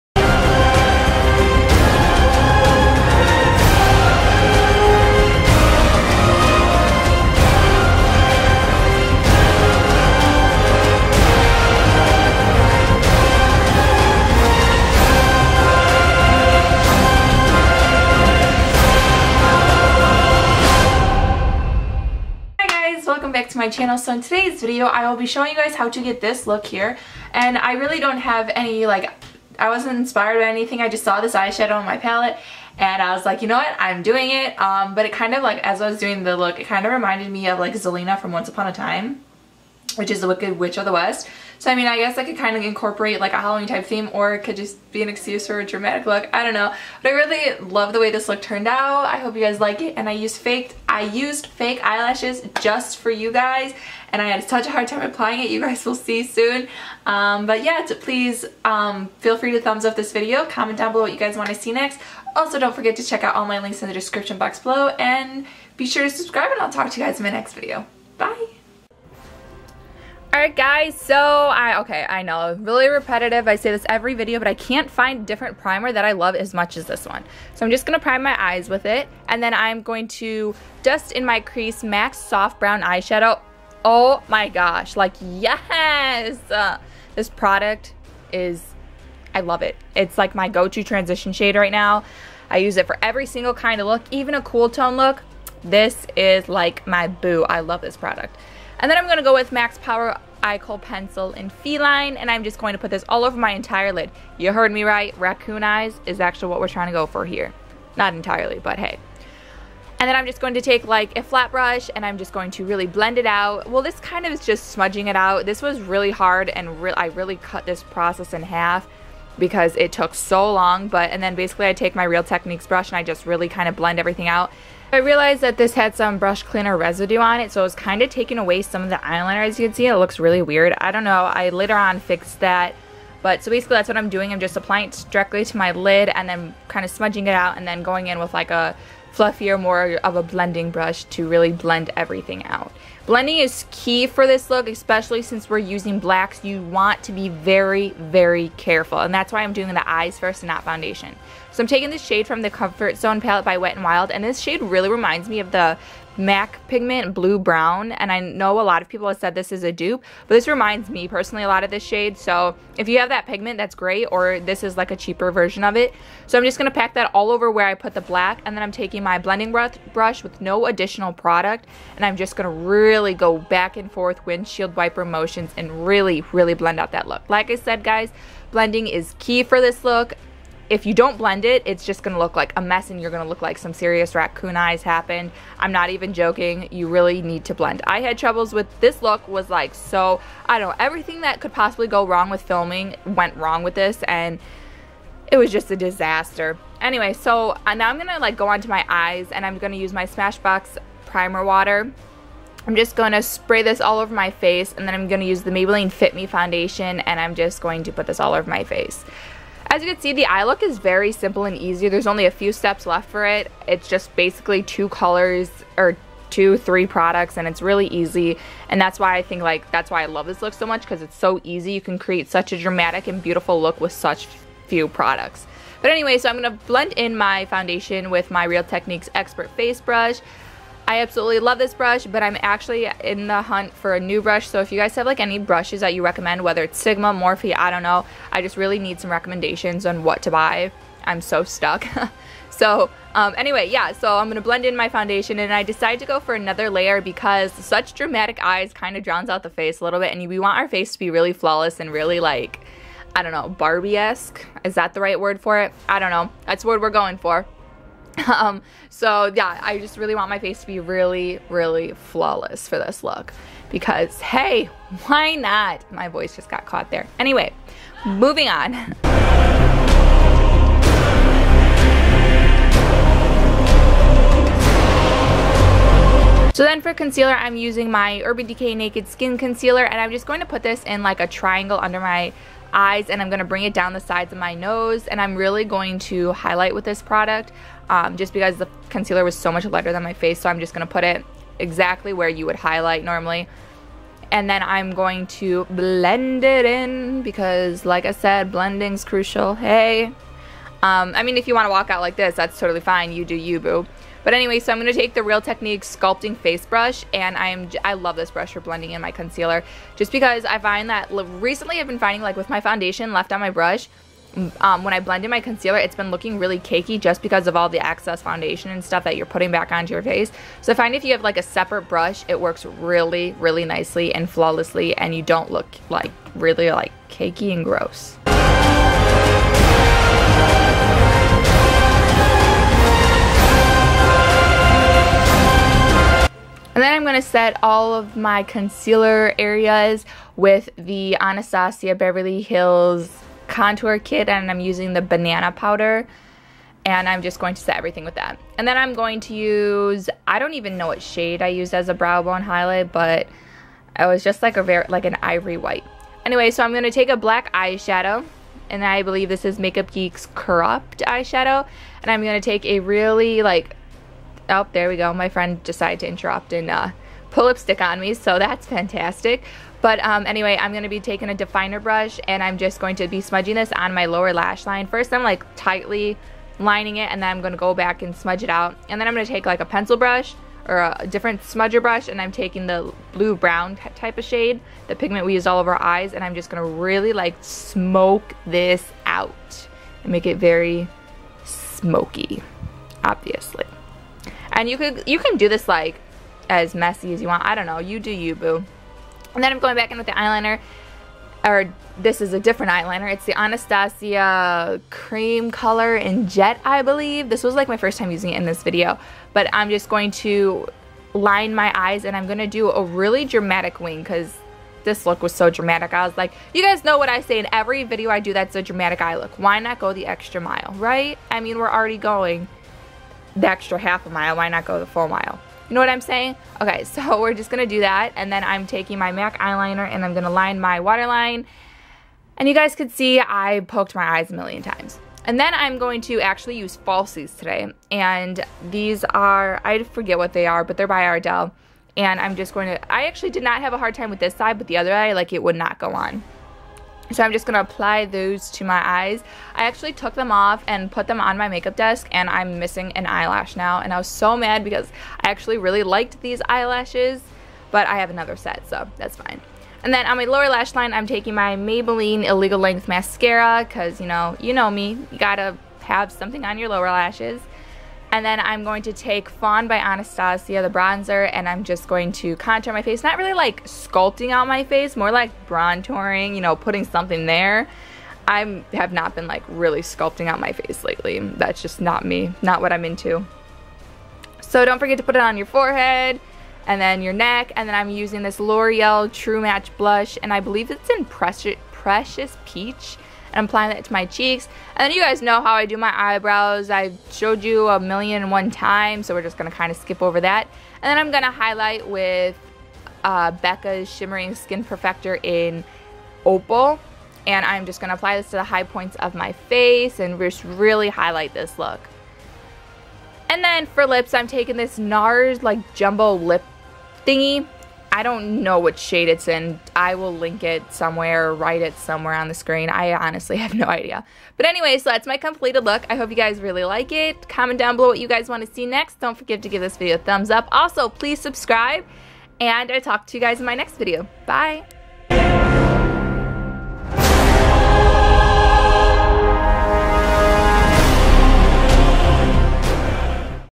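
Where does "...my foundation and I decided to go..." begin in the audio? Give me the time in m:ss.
4:04.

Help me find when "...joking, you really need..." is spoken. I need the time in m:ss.
3:06.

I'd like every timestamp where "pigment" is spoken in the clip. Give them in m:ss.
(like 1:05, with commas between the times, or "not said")
2:36, 2:43, 6:24.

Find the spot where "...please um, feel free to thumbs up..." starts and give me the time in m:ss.
0:57.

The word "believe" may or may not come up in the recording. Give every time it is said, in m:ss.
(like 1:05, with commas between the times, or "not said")
5:59, 6:46, 8:10.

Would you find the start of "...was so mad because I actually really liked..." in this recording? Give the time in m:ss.
7:33.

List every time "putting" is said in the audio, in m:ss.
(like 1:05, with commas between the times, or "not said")
5:19, 7:56.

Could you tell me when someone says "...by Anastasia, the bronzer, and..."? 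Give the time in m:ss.
7:49.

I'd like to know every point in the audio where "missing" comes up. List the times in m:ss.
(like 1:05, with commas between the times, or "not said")
7:32.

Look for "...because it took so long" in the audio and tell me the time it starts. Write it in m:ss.
1:59.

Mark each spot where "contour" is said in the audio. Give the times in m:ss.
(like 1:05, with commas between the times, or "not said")
5:43, 7:52.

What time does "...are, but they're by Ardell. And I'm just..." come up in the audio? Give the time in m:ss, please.
7:20.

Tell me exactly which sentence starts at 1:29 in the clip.
It's like my go-to transition shade right now.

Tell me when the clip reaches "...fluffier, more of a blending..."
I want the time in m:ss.
2:19.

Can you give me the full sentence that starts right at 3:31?
There's only a few steps left for it.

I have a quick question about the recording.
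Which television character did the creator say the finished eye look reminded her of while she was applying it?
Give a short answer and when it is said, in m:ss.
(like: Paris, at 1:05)
Zelena, at 0:37.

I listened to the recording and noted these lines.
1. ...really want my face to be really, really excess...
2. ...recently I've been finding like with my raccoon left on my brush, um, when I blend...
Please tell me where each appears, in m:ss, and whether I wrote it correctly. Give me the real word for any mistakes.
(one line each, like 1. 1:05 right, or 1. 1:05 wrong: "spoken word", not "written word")
1. 4:19 wrong: "flawless", not "excess"
2. 5:11 wrong: "foundation", not "raccoon".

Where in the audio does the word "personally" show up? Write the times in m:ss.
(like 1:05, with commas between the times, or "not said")
2:41.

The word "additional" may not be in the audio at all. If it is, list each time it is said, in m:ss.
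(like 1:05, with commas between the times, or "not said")
2:50.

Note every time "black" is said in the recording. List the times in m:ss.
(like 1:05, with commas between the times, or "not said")
2:25, 2:48, 5:57.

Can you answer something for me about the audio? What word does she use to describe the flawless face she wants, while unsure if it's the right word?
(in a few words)
Barbie-esque.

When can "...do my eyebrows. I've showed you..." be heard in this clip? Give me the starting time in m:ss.
8:15.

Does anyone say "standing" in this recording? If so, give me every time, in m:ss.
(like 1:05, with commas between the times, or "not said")
not said.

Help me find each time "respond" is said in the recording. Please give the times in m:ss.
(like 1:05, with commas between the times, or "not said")
not said.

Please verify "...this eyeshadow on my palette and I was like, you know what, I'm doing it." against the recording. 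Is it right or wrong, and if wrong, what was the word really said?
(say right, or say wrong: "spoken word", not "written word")
right.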